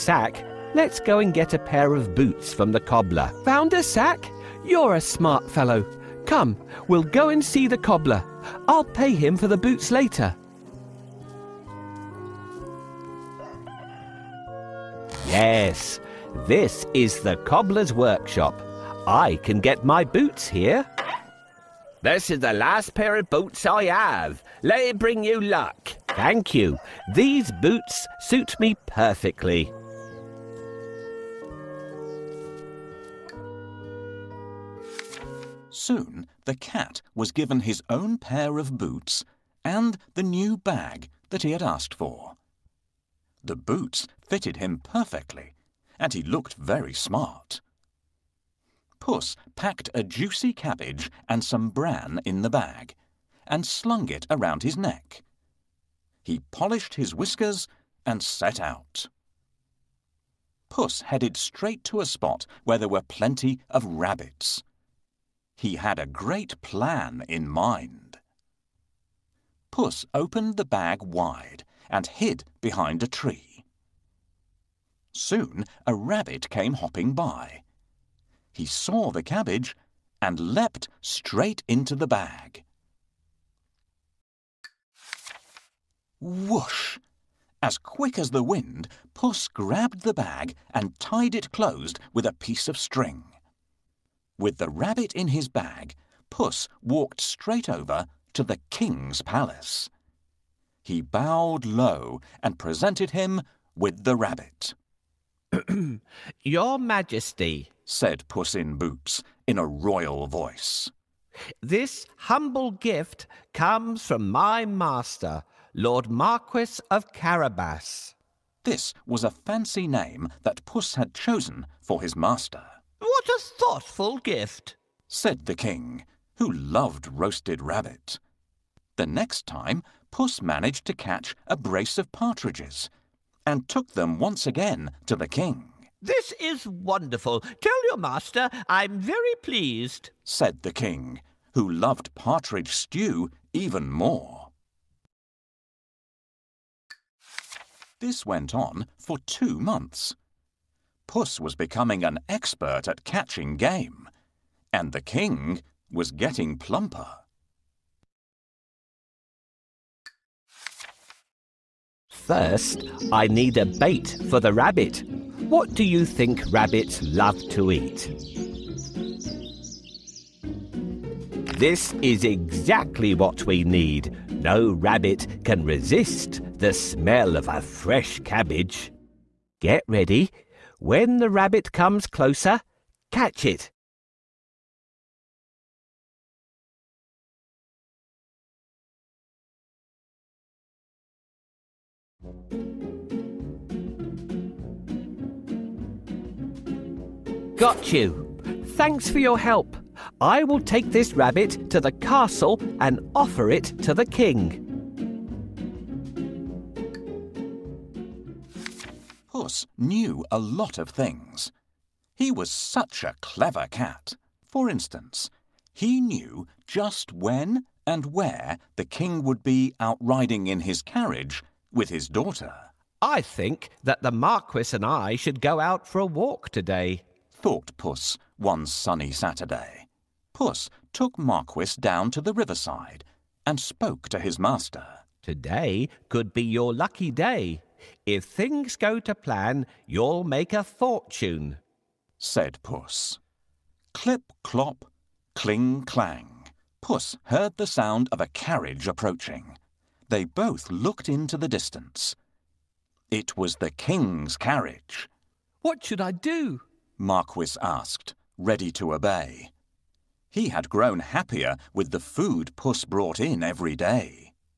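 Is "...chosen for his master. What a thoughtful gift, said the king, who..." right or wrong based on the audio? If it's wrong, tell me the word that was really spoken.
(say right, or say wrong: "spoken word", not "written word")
right.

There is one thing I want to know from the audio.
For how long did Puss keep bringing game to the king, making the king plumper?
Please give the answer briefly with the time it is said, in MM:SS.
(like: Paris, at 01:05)
2 months, at 02:29.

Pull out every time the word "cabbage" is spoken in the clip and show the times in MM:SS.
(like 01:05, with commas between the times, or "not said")
00:50, 01:19, 02:58.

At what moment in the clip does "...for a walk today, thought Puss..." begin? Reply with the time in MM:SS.
03:45.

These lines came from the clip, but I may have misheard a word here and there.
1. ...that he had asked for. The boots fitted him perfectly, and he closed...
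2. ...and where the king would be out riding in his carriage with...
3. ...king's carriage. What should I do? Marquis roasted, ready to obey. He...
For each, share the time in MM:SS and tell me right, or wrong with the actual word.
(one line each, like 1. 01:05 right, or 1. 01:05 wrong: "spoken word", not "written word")
1. 00:41 wrong: "looked", not "closed"
2. 03:37 right
3. 04:13 wrong: "asked", not "roasted".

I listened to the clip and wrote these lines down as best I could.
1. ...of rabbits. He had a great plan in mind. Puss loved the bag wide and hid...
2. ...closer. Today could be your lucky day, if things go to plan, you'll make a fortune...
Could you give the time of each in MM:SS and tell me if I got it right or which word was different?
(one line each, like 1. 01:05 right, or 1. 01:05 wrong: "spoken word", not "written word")
1. 01:03 wrong: "opened", not "loved"
2. 03:54 wrong: "master", not "closer".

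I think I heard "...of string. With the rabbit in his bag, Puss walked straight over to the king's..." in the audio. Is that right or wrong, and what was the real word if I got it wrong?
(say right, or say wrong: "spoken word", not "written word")
right.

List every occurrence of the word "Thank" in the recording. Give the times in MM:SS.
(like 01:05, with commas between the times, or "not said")
00:26, 03:18.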